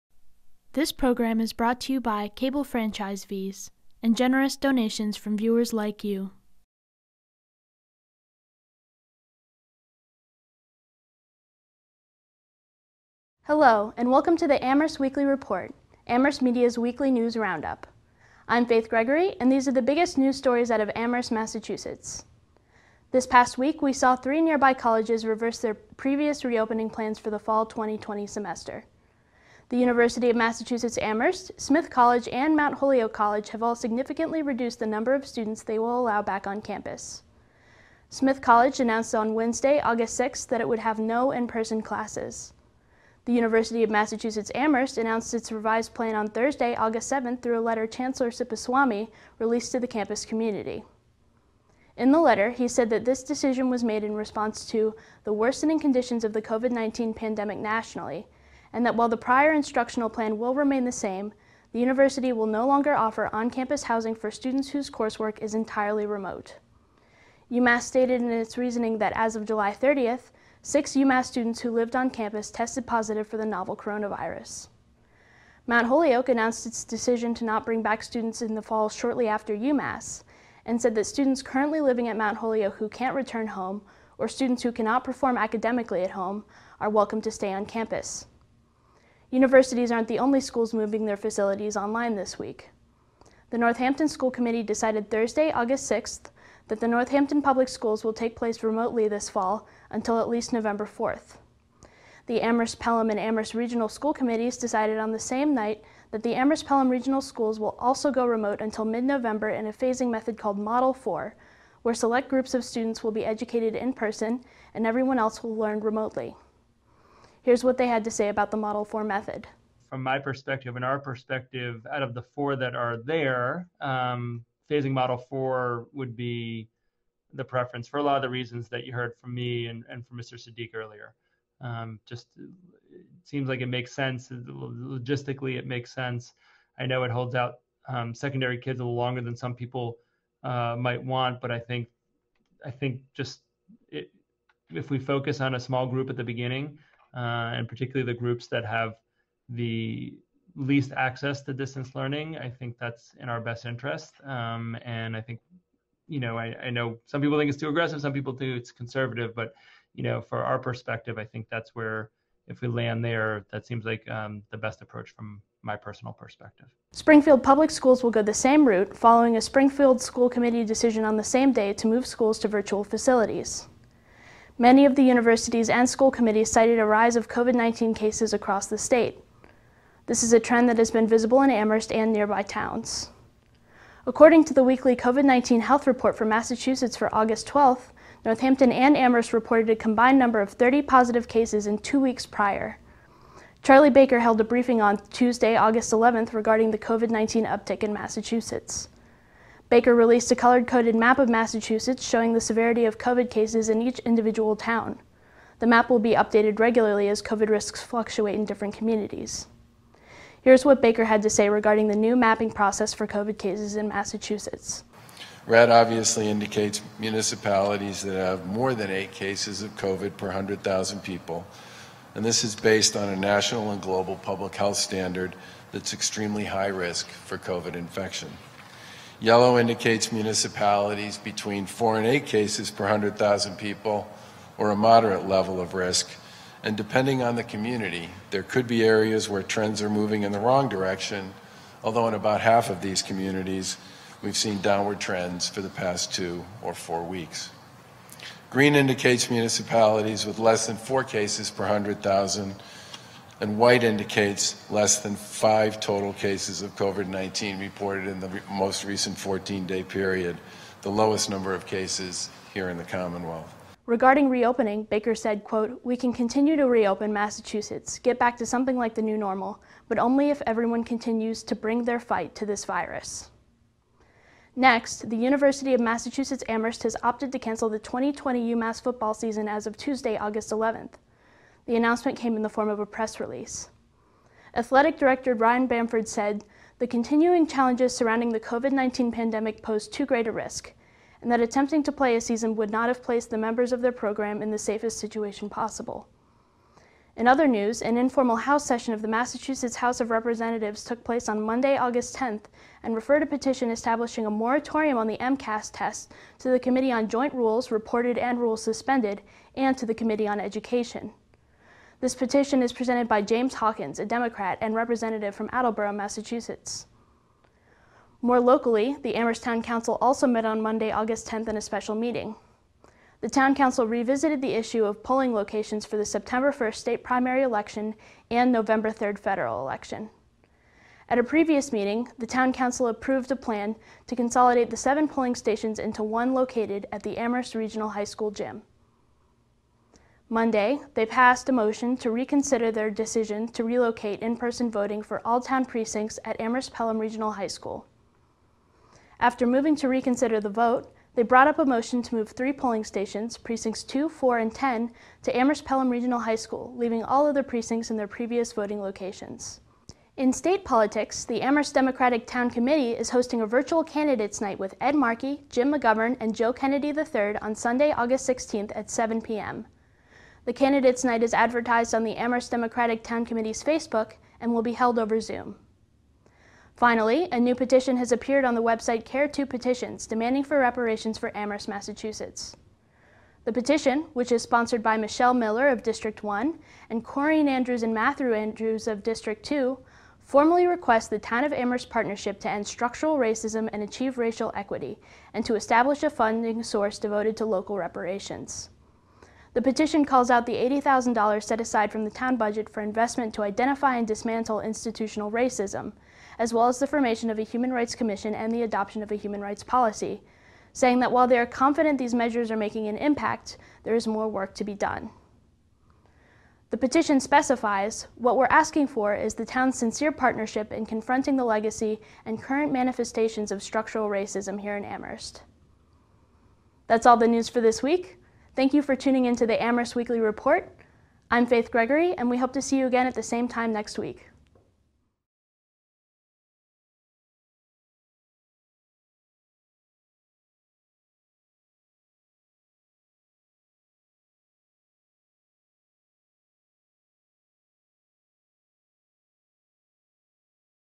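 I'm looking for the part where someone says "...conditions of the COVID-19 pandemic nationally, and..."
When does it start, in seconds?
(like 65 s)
55 s.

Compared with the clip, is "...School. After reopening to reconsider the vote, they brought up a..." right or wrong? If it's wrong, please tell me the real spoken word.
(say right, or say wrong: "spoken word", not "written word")
wrong: "moving", not "reopening".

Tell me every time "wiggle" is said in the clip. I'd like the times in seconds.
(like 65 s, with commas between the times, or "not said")
not said.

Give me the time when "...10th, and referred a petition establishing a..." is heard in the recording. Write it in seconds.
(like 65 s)
302 s.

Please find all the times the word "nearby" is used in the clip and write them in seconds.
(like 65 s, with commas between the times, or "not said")
24 s, 182 s.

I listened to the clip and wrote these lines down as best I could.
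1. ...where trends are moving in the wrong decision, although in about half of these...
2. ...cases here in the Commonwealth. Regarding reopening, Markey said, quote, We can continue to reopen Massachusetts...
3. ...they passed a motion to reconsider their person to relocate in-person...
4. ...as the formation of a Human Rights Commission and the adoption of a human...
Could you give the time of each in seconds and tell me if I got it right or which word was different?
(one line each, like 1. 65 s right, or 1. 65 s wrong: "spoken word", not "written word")
1. 239 s wrong: "direction", not "decision"
2. 261 s wrong: "Baker", not "Markey"
3. 340 s wrong: "decision", not "person"
4. 406 s right.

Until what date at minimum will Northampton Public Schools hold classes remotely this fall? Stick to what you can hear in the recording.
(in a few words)
November 4th.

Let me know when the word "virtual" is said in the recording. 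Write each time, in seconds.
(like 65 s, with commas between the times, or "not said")
172 s, 363 s.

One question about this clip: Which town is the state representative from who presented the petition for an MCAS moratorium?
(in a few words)
Attleboro.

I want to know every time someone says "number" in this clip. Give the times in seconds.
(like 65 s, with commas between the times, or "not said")
34 s, 190 s, 261 s.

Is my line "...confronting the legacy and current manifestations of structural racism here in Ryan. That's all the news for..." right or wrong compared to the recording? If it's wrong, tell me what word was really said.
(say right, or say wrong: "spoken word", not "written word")
wrong: "Amherst", not "Ryan".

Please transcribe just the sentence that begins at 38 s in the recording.
Smith College announced on Wednesday, August 6th, that it would have no in-person classes.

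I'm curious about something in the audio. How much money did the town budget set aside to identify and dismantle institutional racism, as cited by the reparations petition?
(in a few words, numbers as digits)
$80,000.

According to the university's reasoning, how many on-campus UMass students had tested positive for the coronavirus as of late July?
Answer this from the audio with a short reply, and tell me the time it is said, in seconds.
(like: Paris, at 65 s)
6, at 70 s.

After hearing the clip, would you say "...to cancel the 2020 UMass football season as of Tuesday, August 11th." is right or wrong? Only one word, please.
right.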